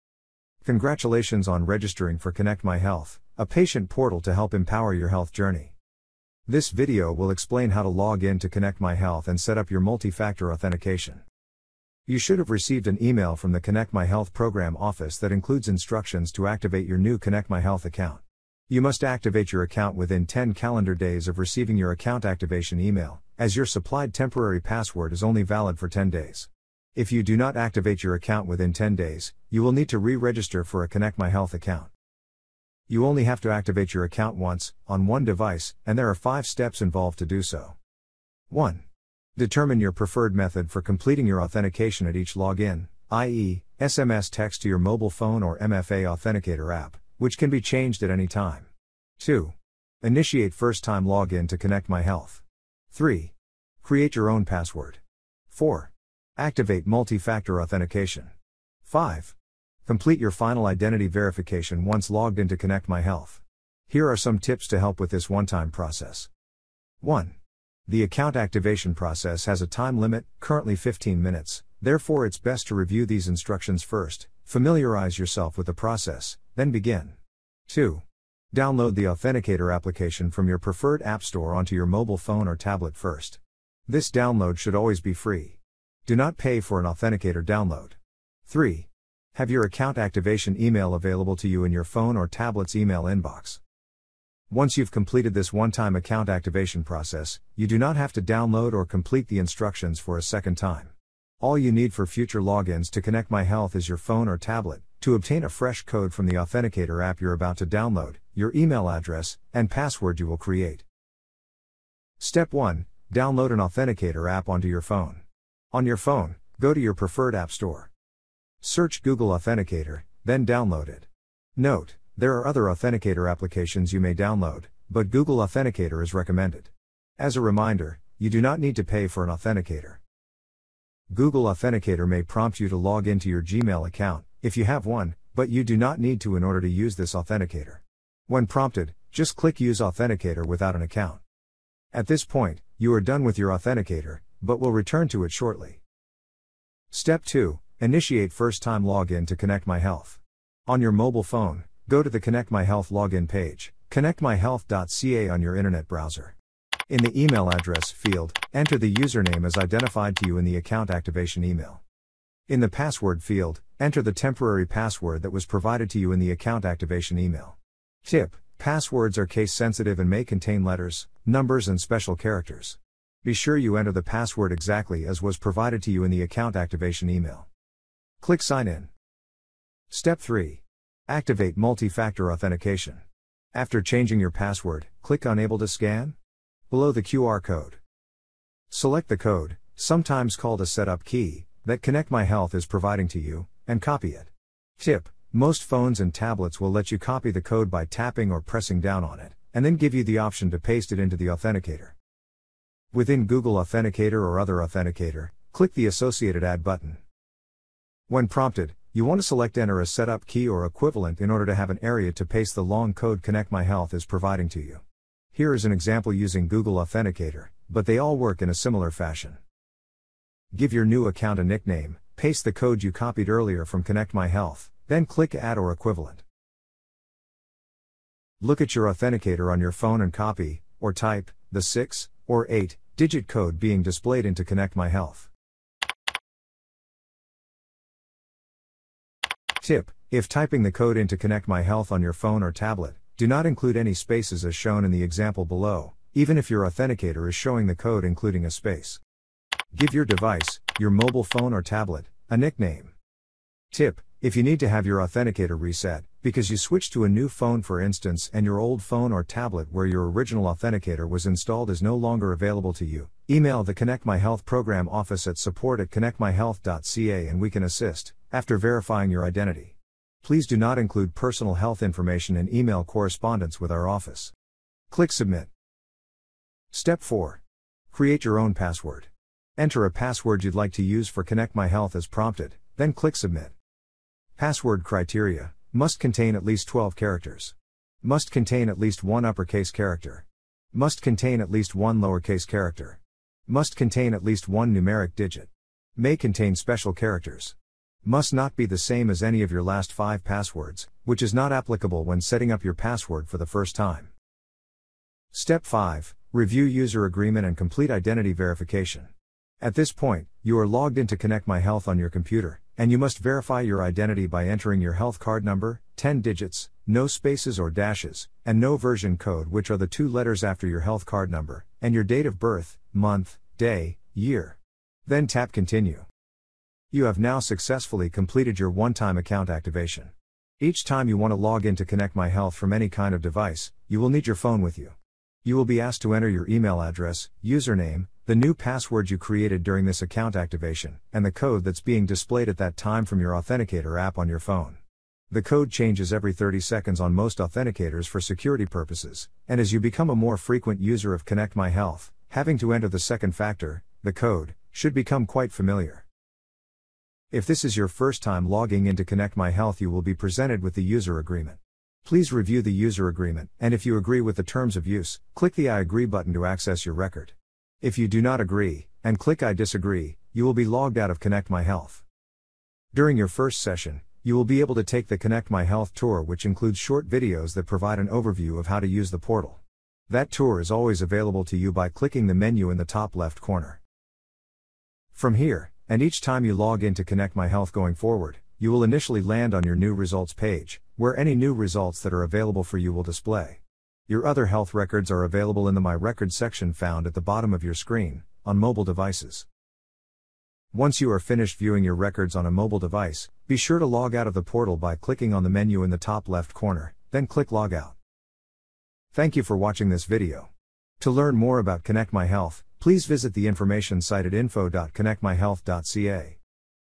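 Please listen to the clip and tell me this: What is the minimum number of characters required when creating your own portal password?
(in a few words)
12.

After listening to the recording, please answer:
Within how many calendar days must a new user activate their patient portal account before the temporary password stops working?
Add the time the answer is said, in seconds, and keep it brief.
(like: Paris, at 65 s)
10, at 20 s.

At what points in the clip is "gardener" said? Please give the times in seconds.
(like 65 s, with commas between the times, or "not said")
not said.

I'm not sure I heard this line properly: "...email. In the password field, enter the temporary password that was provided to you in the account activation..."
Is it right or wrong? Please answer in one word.
right.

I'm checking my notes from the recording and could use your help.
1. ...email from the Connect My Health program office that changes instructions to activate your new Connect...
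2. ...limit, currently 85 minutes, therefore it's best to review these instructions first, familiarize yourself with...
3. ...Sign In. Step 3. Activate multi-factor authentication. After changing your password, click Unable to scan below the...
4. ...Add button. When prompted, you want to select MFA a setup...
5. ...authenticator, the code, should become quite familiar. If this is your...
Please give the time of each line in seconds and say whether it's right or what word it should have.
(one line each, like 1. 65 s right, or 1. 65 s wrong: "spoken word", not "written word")
1. 13 s wrong: "includes", not "changes"
2. 69 s wrong: "15", not "85"
3. 178 s right
4. 206 s wrong: "Enter", not "MFA"
5. 353 s wrong: "factor", not "authenticator".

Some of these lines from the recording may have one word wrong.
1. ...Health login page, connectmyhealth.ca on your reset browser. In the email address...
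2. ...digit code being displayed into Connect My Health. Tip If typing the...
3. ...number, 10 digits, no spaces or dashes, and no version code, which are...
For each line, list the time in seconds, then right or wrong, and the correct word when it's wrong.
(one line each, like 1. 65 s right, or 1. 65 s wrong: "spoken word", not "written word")
1. 152 s wrong: "internet", not "reset"
2. 233 s right
3. 315 s right.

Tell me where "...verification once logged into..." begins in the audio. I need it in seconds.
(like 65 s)
61 s.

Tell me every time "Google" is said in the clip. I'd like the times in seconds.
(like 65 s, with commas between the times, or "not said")
119 s, 125 s, 131 s, 203 s, 216 s.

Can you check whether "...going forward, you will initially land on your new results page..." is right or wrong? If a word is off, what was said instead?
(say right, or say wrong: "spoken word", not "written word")
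right.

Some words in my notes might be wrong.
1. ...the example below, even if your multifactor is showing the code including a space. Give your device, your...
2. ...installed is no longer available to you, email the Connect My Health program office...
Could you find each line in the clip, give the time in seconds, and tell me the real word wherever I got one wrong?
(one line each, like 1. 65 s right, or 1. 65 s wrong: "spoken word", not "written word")
1. 244 s wrong: "authenticator", not "multifactor"
2. 261 s right.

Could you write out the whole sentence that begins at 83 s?
This download should always be free.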